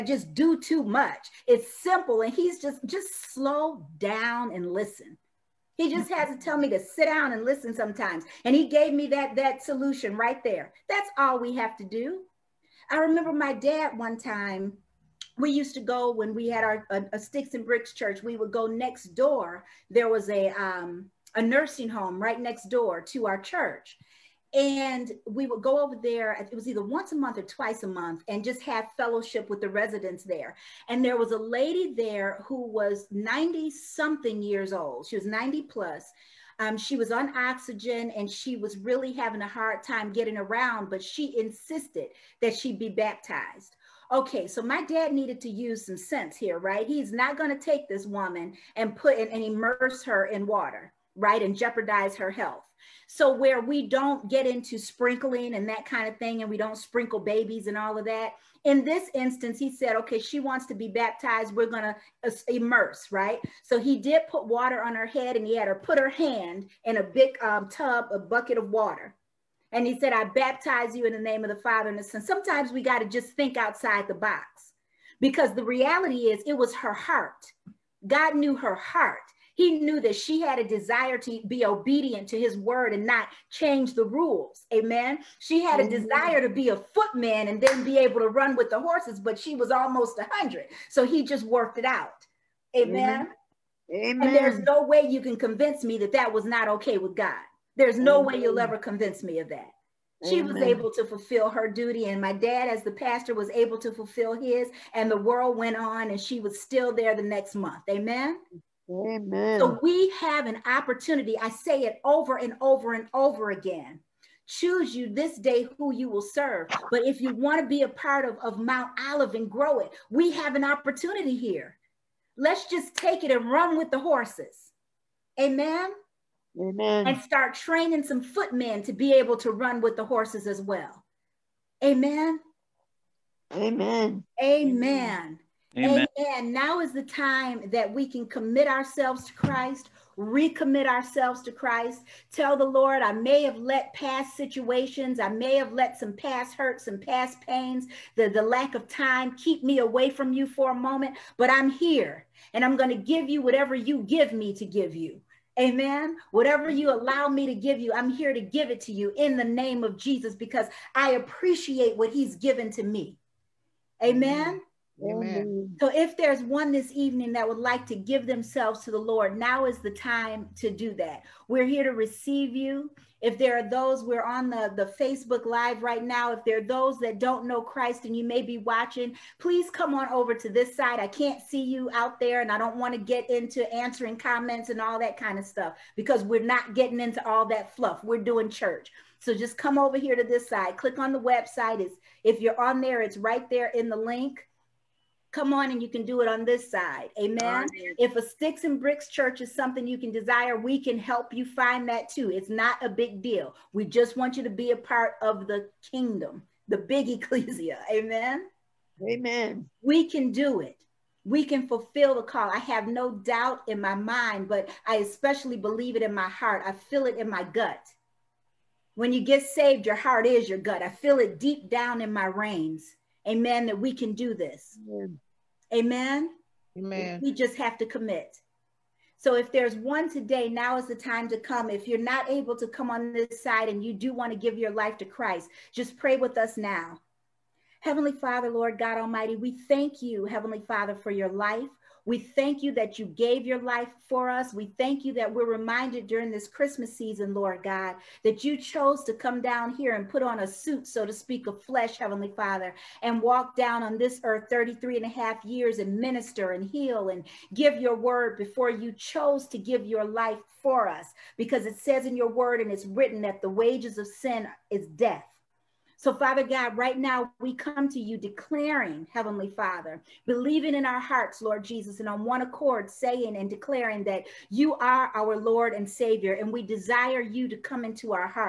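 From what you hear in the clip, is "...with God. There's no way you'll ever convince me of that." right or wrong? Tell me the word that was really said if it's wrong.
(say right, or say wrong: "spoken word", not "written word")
right.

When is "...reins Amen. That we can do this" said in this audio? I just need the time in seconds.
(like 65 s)
222 s.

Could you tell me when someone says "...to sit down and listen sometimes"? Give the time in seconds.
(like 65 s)
6 s.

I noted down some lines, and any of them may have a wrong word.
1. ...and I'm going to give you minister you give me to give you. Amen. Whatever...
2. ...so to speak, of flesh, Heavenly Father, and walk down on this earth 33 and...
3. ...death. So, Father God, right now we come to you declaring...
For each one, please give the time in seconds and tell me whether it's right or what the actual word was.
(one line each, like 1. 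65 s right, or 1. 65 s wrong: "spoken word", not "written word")
1. 152 s wrong: "whatever", not "minister"
2. 250 s right
3. 264 s right.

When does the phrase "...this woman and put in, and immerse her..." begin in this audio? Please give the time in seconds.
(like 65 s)
47 s.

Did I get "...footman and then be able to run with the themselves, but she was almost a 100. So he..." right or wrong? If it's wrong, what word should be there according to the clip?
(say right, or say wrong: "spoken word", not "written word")
wrong: "horses", not "themselves".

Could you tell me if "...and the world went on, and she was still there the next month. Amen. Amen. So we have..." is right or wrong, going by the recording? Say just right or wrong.
right.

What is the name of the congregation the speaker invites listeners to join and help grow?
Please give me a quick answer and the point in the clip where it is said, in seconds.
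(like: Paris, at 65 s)
Mount Olive, at 118 s.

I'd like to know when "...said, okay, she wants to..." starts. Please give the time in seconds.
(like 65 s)
59 s.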